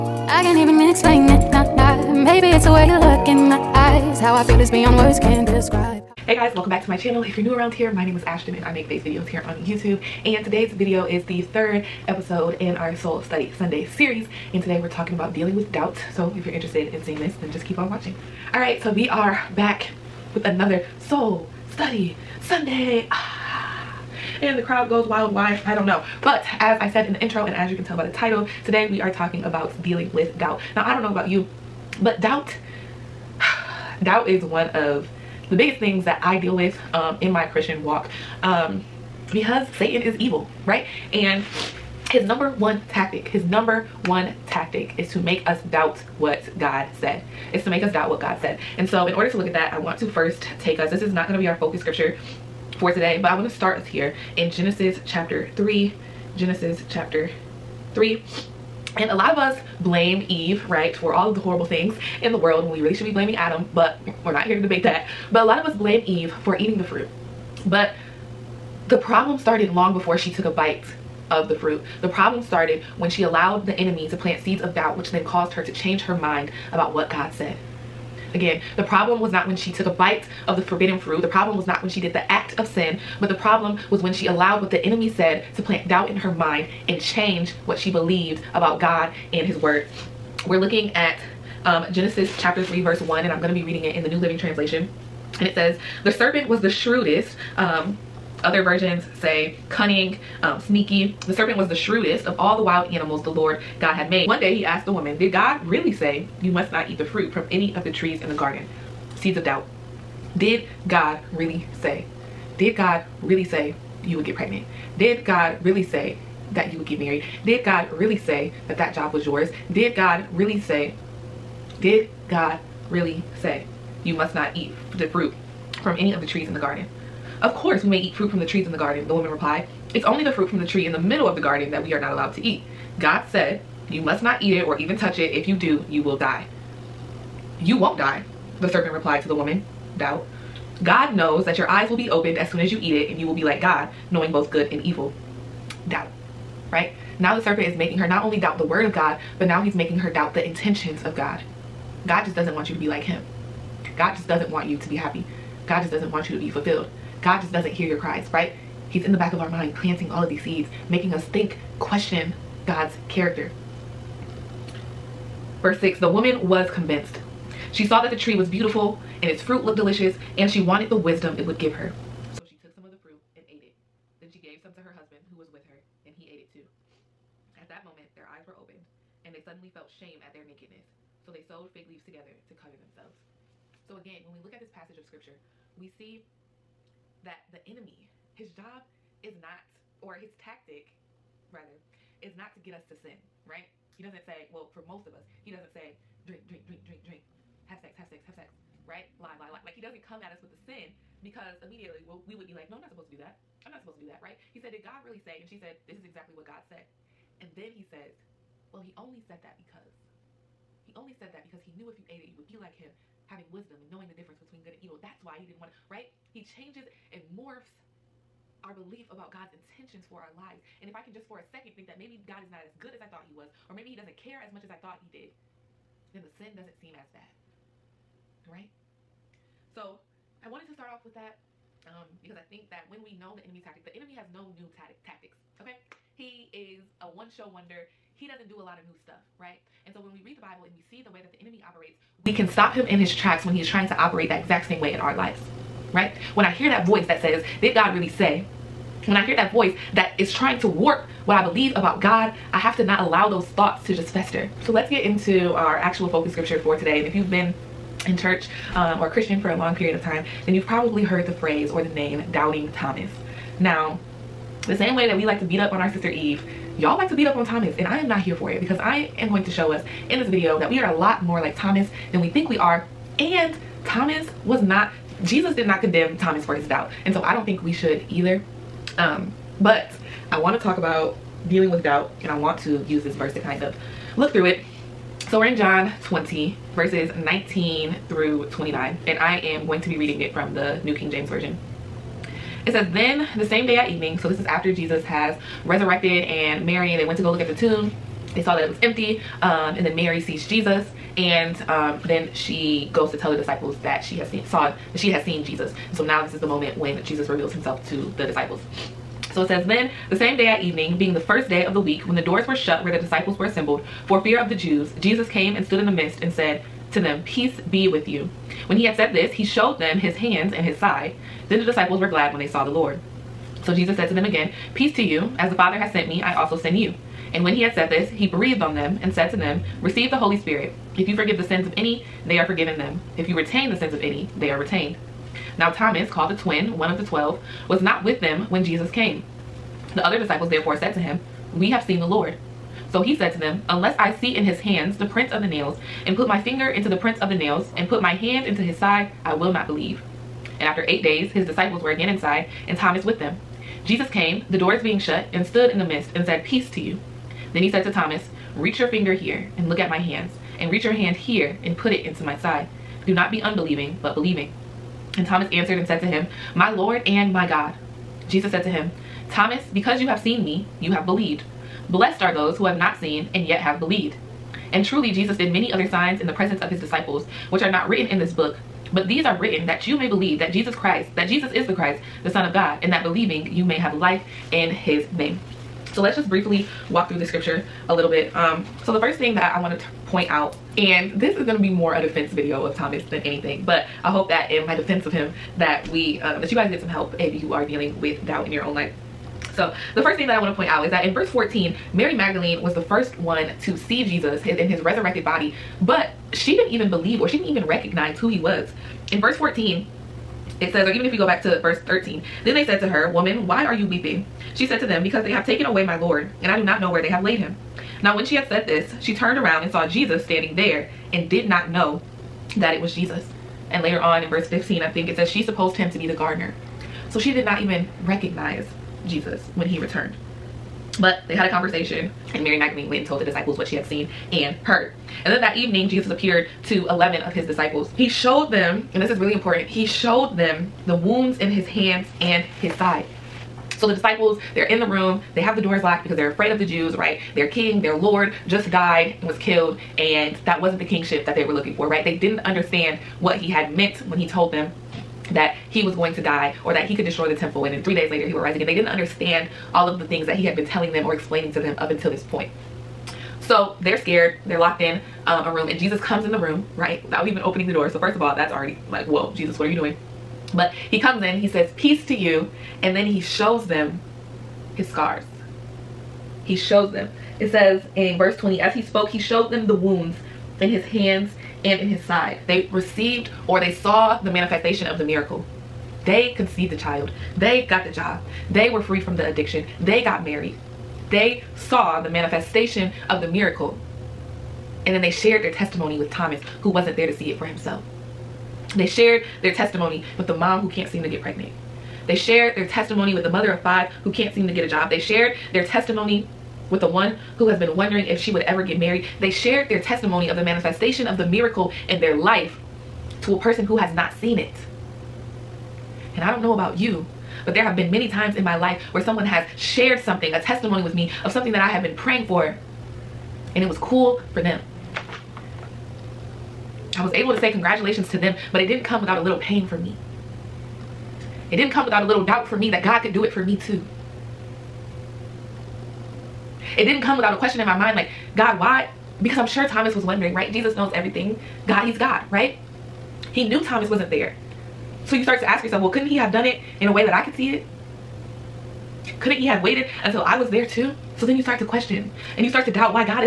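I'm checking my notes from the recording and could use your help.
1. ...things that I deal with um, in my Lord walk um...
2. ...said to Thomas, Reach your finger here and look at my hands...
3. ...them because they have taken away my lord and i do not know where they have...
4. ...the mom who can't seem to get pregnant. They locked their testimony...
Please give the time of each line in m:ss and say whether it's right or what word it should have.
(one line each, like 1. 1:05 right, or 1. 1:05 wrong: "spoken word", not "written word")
1. 0:35 wrong: "Christian", not "Lord"
2. 5:57 right
3. 6:54 right
4. 8:20 wrong: "shared", not "locked".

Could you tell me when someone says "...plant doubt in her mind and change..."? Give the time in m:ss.
1:25.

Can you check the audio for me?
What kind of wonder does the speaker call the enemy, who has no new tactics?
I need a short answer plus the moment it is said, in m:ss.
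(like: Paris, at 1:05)
one-show wonder, at 3:57.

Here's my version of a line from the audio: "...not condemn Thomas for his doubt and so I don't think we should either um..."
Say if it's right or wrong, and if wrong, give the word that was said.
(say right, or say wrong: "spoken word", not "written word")
right.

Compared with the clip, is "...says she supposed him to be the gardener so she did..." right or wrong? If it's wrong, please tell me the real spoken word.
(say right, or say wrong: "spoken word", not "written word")
right.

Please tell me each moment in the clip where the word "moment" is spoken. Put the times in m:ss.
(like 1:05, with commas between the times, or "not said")
2:57, 5:06.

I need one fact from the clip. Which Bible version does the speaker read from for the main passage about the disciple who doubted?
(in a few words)
New King James Version.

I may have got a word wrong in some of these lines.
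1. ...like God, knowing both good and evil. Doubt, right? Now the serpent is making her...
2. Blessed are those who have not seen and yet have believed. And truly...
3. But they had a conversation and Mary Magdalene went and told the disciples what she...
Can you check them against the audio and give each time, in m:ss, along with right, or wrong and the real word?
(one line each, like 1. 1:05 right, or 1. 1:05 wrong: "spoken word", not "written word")
1. 2:23 right
2. 6:11 right
3. 7:10 right.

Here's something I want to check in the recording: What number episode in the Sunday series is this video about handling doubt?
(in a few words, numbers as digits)
third.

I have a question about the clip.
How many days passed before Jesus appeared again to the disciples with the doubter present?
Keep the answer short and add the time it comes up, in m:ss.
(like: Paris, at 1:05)
8, at 5:50.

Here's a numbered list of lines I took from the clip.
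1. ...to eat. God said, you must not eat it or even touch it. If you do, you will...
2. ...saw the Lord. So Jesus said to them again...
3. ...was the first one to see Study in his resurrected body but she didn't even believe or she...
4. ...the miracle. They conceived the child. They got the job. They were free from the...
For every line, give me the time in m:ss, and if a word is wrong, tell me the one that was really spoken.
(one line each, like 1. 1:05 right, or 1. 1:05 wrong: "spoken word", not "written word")
1. 2:12 right
2. 5:22 right
3. 6:42 wrong: "Jesus", not "Study"
4. 8:04 right.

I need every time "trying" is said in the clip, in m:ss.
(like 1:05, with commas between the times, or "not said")
4:03, 4:10.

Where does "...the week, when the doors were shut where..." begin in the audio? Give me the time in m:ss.
5:11.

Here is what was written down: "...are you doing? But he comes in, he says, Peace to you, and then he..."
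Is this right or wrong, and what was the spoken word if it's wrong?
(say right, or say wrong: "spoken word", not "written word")
right.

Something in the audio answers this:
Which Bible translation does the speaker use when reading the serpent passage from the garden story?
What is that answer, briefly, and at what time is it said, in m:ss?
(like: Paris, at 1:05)
New Living Translation, at 1:34.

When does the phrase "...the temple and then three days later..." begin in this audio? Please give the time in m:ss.
7:37.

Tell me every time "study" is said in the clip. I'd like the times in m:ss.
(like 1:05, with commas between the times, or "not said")
0:13, 0:21.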